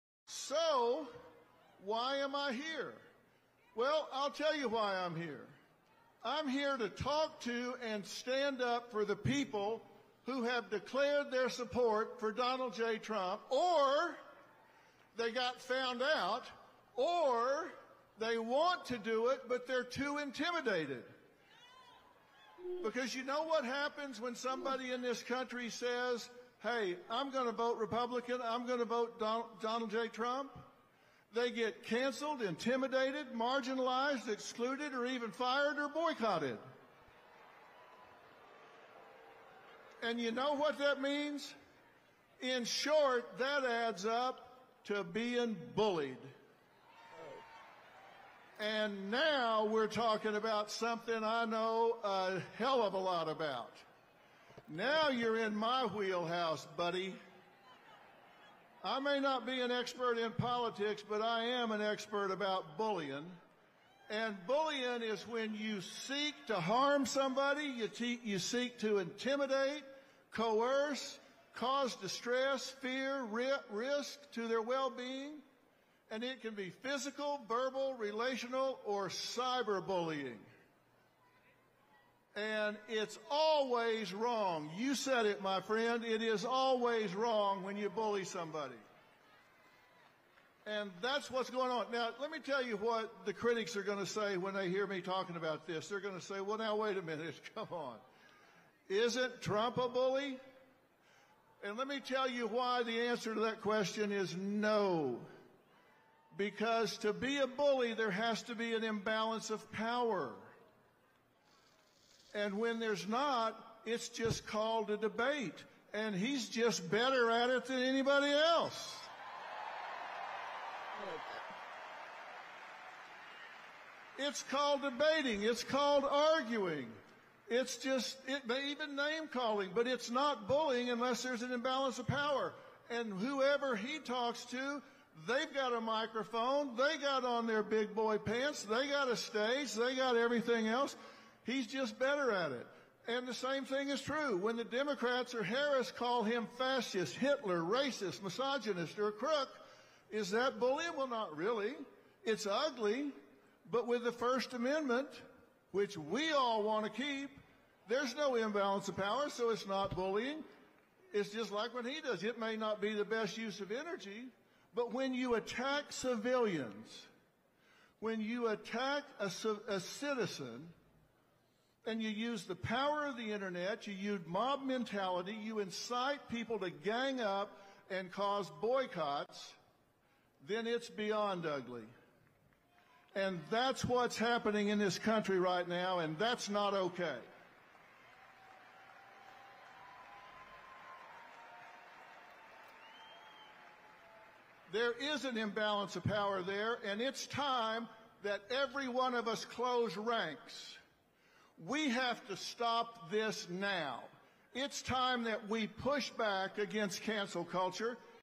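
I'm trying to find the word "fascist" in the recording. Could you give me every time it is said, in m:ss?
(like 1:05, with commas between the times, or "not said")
2:26.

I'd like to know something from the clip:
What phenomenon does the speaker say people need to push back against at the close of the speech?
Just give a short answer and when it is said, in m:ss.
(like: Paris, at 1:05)
Cancel culture, at 3:27.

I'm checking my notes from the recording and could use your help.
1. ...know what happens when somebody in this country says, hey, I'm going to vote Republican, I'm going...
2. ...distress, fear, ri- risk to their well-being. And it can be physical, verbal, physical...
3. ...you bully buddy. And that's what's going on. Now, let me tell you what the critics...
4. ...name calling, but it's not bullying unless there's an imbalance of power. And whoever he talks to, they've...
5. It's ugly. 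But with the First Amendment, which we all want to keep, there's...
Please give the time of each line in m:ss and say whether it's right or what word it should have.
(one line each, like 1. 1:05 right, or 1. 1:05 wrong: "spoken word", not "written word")
1. 0:23 right
2. 1:11 wrong: "relational", not "physical"
3. 1:27 wrong: "somebody", not "buddy"
4. 2:08 right
5. 2:32 right.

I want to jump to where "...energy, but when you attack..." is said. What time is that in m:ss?
2:43.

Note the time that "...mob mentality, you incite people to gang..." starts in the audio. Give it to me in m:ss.
2:54.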